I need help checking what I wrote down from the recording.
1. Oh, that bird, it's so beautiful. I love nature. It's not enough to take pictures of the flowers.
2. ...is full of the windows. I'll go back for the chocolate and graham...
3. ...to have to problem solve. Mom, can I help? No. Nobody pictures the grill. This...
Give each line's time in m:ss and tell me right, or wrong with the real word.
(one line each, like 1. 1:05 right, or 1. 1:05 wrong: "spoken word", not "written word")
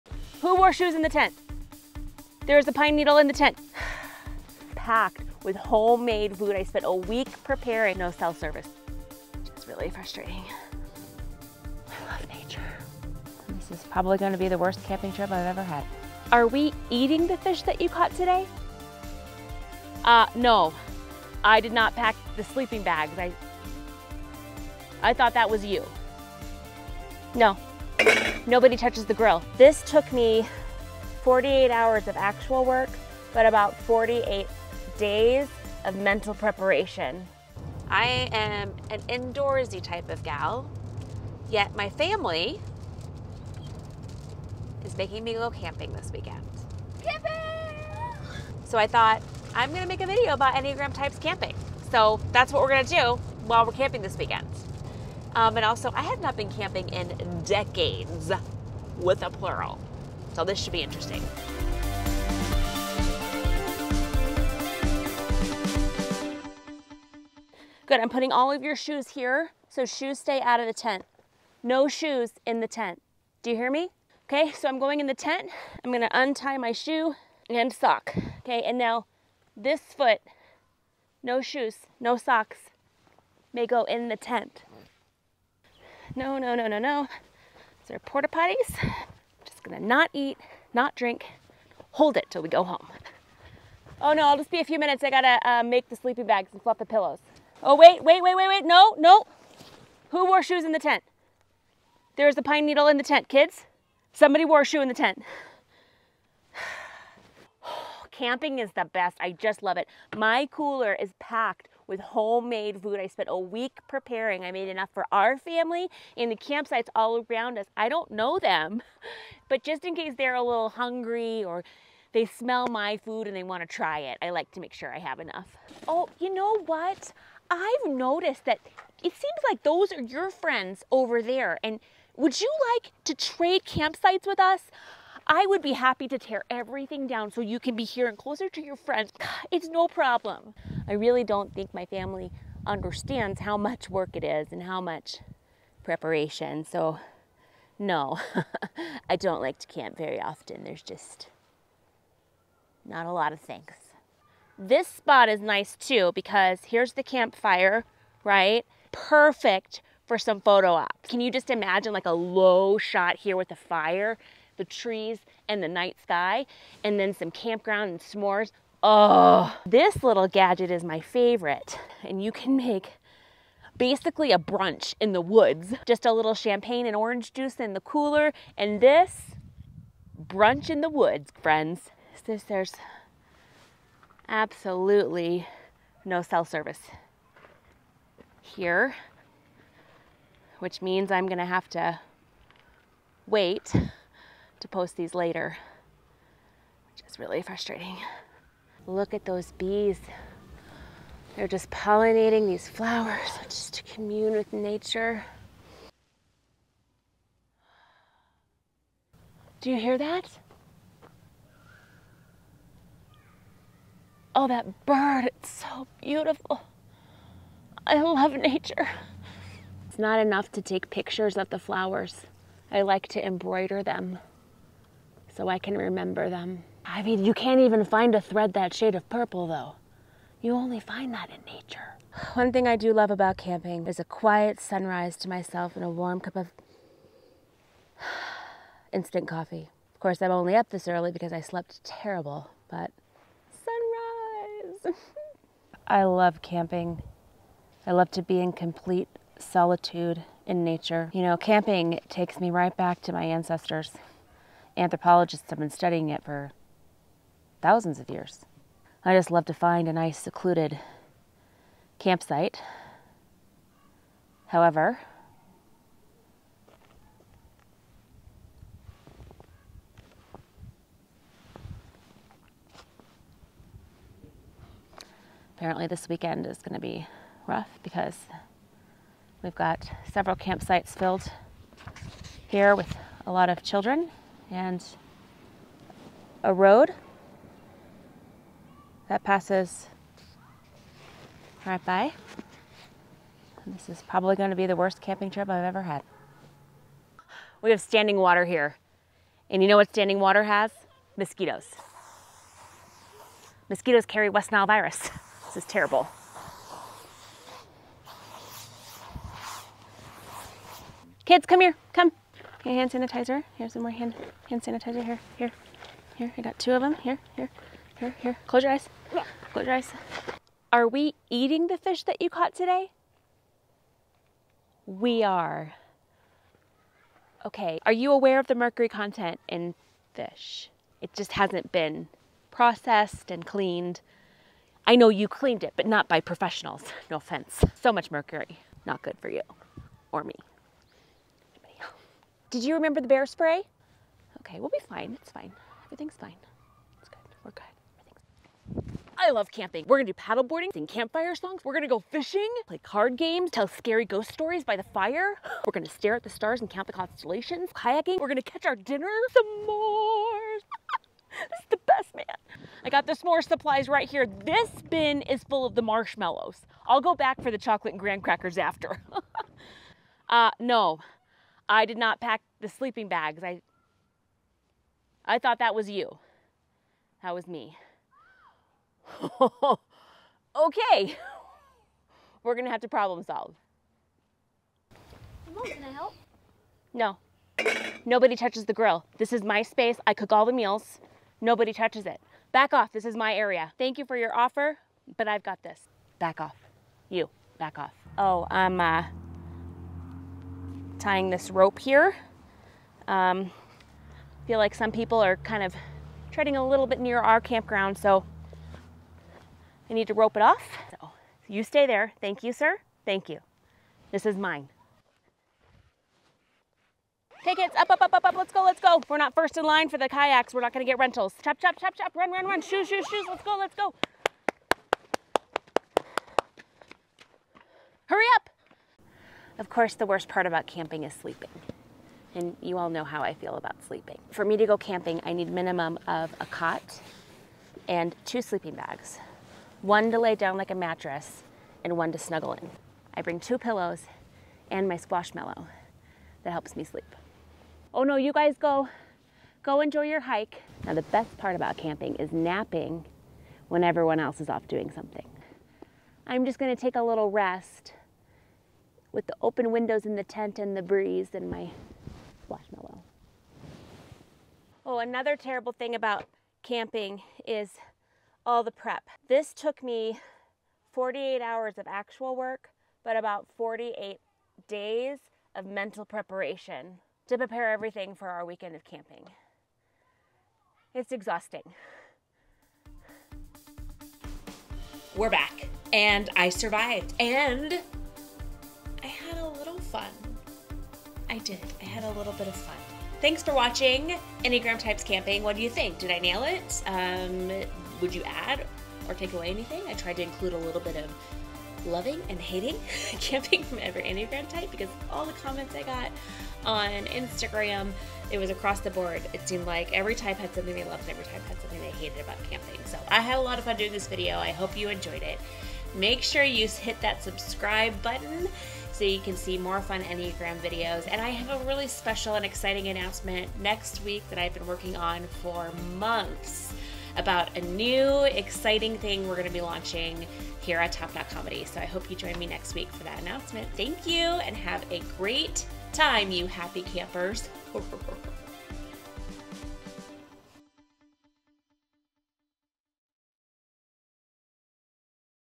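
1. 3:34 right
2. 6:05 wrong: "marshmallows", not "windows"
3. 6:22 wrong: "touches", not "pictures".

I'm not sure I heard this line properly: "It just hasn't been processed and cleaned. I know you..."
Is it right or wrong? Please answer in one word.
right.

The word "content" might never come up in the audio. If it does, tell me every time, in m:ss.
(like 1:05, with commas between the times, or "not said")
5:28.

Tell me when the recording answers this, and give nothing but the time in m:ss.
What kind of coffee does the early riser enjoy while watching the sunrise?
3:58.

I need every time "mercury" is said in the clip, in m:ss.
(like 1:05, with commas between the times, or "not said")
5:28, 5:38.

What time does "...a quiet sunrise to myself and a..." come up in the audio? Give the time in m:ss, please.
3:53.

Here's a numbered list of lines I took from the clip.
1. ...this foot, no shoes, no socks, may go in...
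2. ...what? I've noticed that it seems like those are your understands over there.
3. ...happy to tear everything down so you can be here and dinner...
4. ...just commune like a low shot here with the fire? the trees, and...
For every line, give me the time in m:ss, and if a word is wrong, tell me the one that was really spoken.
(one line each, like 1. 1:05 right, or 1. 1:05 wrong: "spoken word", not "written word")
1. 1:19 right
2. 2:06 wrong: "friends", not "understands"
3. 2:15 wrong: "closer", not "dinner"
4. 2:41 wrong: "imagine", not "commune".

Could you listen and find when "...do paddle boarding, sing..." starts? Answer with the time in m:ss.
5:50.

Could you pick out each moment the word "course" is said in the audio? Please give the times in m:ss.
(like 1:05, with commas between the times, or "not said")
4:00, 7:09.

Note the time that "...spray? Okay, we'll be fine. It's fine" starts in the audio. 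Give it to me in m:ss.
5:43.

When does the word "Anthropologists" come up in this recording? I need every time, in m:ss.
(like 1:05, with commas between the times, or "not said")
4:14.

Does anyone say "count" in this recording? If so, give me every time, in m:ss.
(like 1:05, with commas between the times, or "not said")
5:56.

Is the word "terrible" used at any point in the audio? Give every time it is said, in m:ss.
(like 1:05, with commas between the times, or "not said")
4:01, 5:05, 7:45.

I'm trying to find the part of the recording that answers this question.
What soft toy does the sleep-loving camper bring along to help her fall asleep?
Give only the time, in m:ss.
7:24.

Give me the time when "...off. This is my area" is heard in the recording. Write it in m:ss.
6:32.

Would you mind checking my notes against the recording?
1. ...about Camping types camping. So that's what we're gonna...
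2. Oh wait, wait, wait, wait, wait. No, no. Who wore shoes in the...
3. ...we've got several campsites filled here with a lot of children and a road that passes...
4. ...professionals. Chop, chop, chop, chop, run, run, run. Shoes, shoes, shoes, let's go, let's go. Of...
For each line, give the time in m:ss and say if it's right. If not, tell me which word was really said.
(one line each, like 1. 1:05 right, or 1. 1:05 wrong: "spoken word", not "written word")
1. 0:50 wrong: "Enneagram", not "Camping"
2. 1:37 right
3. 4:39 right
4. 7:00 wrong: "rentals", not "professionals".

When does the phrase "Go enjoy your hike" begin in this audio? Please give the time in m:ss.
7:29.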